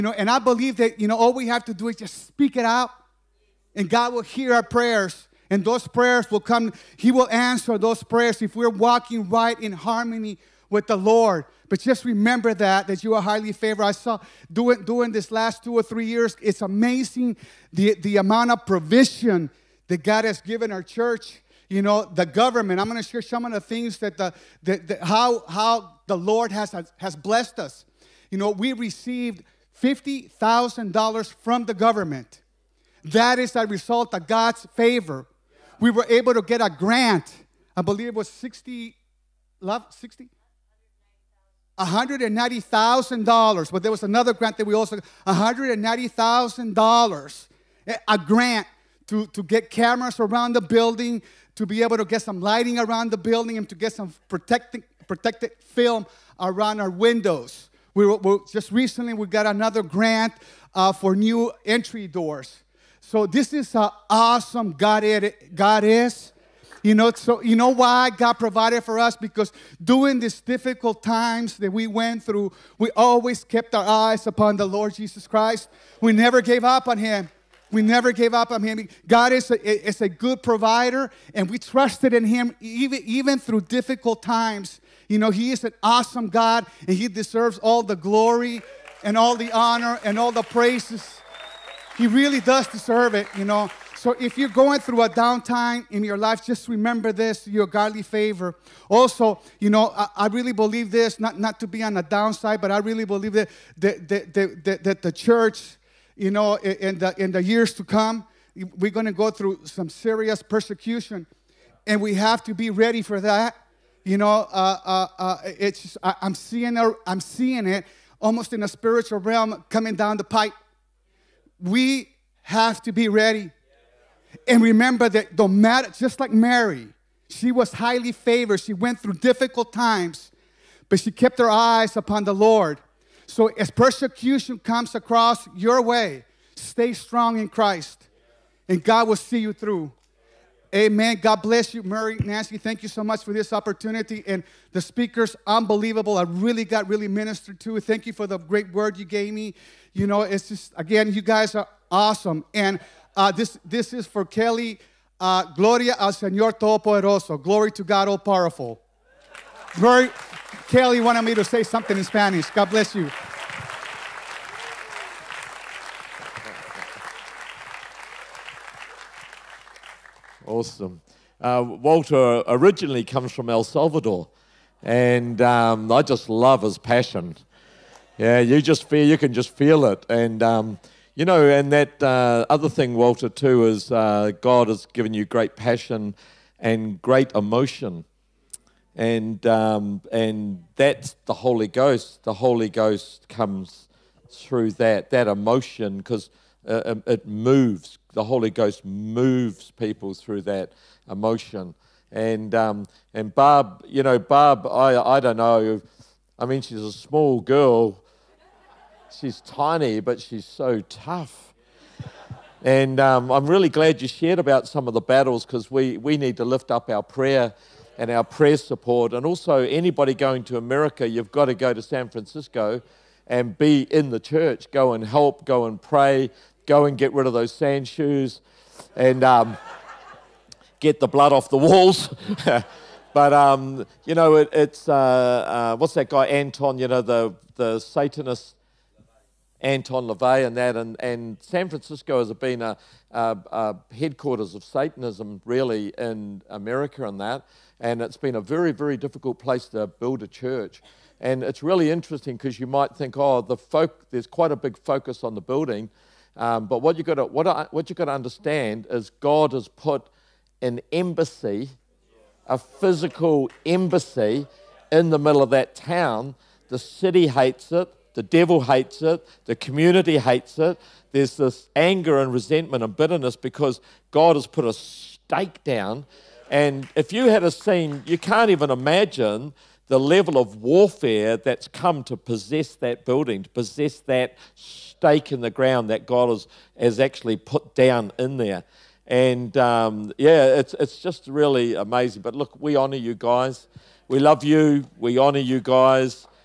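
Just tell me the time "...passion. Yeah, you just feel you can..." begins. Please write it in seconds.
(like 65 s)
176 s.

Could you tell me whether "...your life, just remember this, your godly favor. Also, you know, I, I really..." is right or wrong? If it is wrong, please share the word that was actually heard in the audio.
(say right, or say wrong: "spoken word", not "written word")
right.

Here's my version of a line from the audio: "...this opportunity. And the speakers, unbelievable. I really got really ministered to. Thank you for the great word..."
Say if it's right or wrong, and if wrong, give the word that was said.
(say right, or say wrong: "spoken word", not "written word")
right.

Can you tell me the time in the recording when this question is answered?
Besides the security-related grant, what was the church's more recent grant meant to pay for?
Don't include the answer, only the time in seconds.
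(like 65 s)
61 s.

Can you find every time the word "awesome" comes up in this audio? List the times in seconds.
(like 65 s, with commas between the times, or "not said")
64 s, 85 s, 151 s, 170 s.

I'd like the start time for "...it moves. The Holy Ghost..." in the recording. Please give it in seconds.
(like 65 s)
197 s.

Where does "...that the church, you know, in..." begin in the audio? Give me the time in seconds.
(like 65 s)
104 s.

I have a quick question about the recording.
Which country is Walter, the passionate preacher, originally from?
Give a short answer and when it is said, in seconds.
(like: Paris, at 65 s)
El Salvador, at 173 s.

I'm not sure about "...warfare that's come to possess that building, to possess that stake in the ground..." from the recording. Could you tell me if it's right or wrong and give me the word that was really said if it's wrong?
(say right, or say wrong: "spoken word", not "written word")
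right.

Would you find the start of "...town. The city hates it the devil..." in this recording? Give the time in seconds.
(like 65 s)
265 s.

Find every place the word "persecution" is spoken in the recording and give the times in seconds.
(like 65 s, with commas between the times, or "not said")
110 s, 133 s.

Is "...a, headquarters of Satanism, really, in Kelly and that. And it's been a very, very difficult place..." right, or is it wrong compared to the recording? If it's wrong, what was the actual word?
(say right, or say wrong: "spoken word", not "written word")
wrong: "America", not "Kelly".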